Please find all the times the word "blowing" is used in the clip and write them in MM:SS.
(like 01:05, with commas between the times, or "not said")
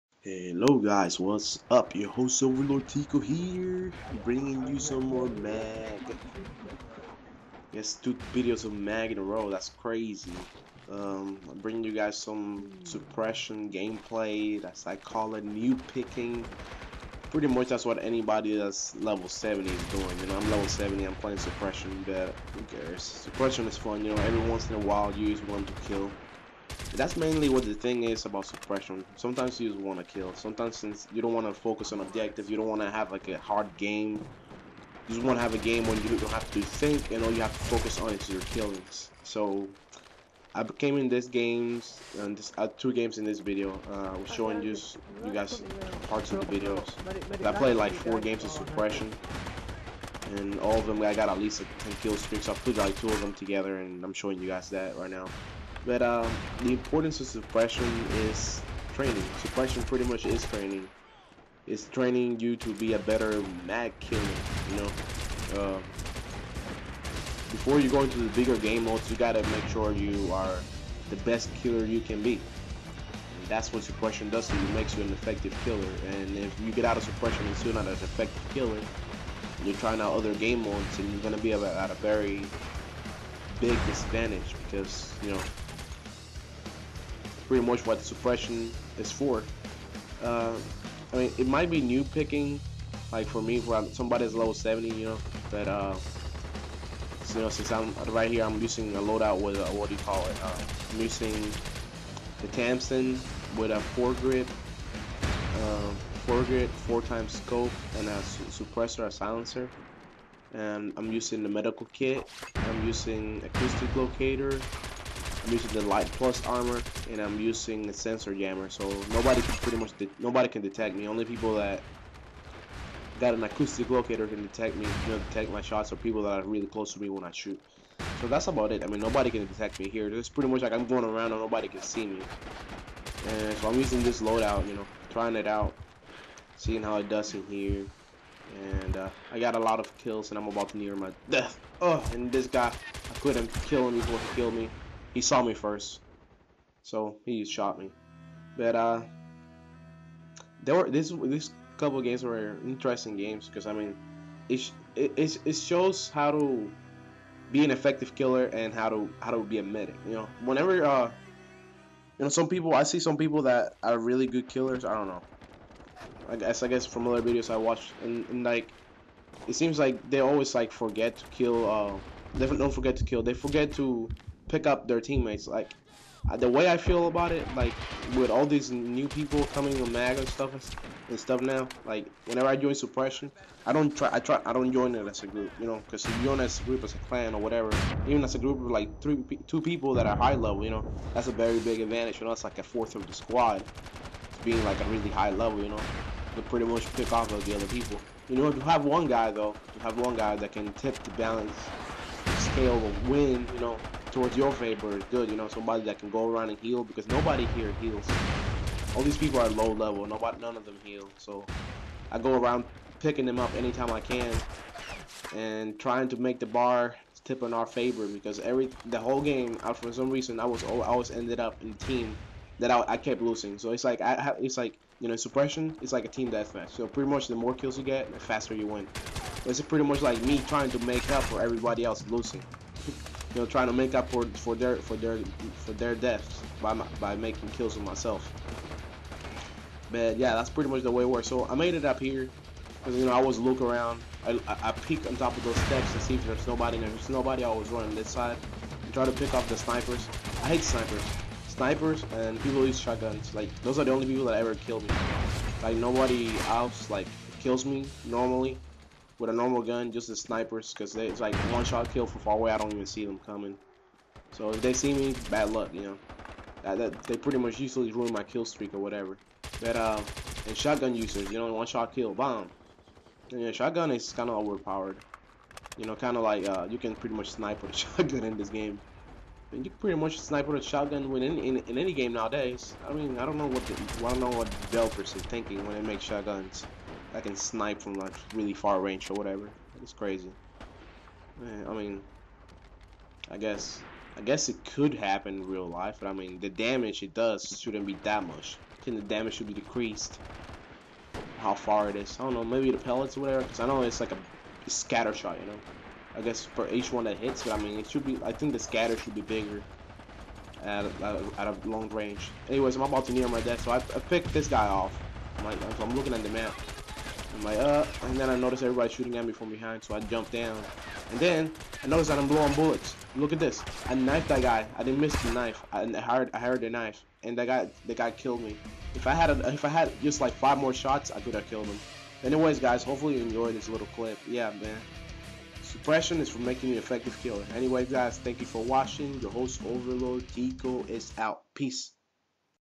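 05:22.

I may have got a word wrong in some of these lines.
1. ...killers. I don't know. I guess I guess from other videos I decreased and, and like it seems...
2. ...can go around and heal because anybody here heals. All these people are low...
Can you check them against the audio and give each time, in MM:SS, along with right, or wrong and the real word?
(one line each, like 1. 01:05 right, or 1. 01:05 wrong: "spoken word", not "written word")
1. 02:44 wrong: "watched", not "decreased"
2. 03:25 wrong: "nobody", not "anybody".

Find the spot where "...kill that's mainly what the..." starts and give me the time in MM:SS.
00:25.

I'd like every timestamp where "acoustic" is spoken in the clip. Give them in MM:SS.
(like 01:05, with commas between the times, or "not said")
01:53, 02:03.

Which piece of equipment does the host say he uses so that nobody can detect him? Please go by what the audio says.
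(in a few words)
Sensor jammer.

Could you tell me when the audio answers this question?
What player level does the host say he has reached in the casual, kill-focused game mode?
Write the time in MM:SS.
00:20.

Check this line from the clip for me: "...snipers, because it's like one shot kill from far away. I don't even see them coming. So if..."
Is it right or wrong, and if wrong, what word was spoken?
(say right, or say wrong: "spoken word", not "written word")
right.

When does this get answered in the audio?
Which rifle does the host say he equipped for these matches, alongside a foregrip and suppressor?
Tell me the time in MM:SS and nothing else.
01:42.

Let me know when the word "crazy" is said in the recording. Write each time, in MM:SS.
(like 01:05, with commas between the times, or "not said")
00:09, 04:49.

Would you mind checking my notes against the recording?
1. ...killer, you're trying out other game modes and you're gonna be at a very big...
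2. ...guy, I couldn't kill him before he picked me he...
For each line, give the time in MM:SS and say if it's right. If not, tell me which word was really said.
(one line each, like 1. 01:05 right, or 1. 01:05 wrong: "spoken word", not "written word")
1. 01:18 right
2. 02:22 wrong: "killed", not "picked".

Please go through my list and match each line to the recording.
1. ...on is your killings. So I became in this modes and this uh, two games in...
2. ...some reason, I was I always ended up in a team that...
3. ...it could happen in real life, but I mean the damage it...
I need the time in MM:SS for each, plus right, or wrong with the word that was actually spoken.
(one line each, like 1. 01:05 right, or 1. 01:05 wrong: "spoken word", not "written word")
1. 00:38 wrong: "games", not "modes"
2. 03:39 right
3. 04:54 right.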